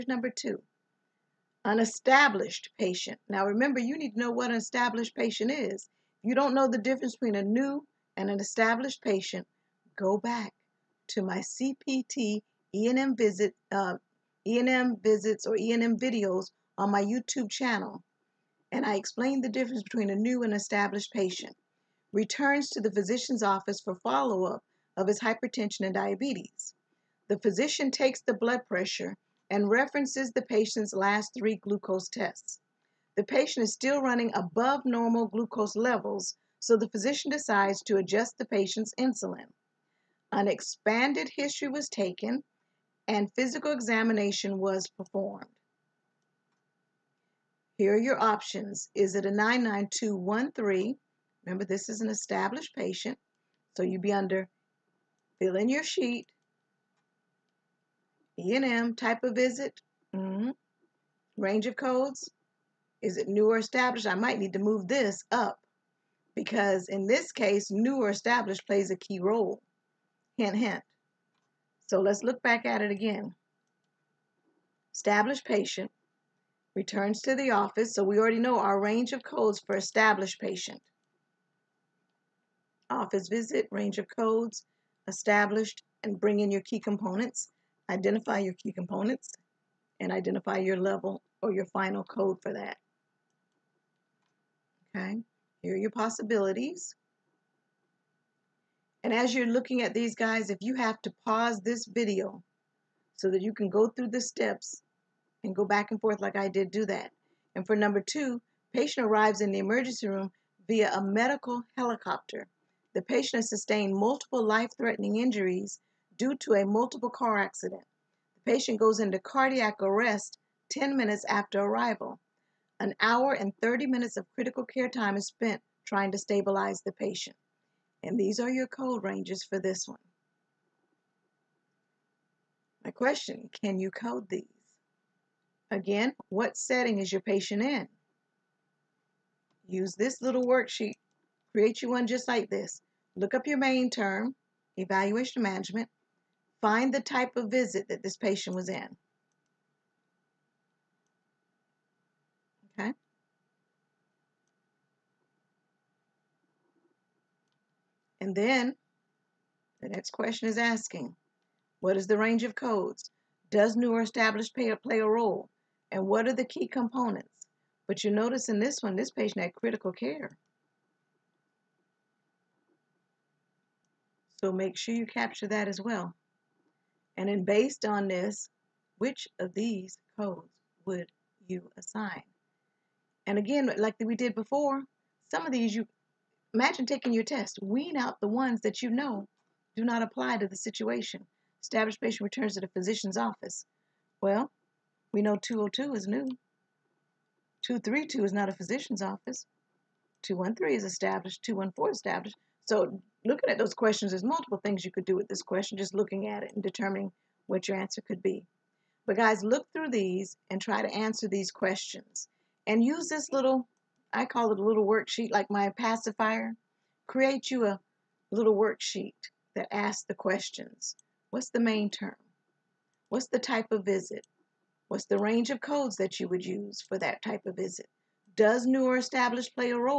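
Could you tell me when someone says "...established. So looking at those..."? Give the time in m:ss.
3:21.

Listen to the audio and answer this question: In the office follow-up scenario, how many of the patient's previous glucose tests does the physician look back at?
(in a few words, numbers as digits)
3.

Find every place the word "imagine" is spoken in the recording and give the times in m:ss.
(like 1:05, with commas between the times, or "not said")
3:06.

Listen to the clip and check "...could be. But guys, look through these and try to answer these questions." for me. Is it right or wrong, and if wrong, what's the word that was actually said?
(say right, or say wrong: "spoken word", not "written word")
right.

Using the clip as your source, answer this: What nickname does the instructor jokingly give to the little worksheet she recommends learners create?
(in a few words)
My pacifier.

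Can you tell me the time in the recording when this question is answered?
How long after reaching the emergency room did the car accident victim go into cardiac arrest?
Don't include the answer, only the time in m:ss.
2:00.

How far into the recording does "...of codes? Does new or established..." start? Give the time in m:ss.
2:42.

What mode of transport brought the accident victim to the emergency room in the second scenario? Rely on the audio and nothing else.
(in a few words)
Medical helicopter.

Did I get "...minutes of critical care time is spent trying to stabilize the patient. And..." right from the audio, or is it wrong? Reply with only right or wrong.
right.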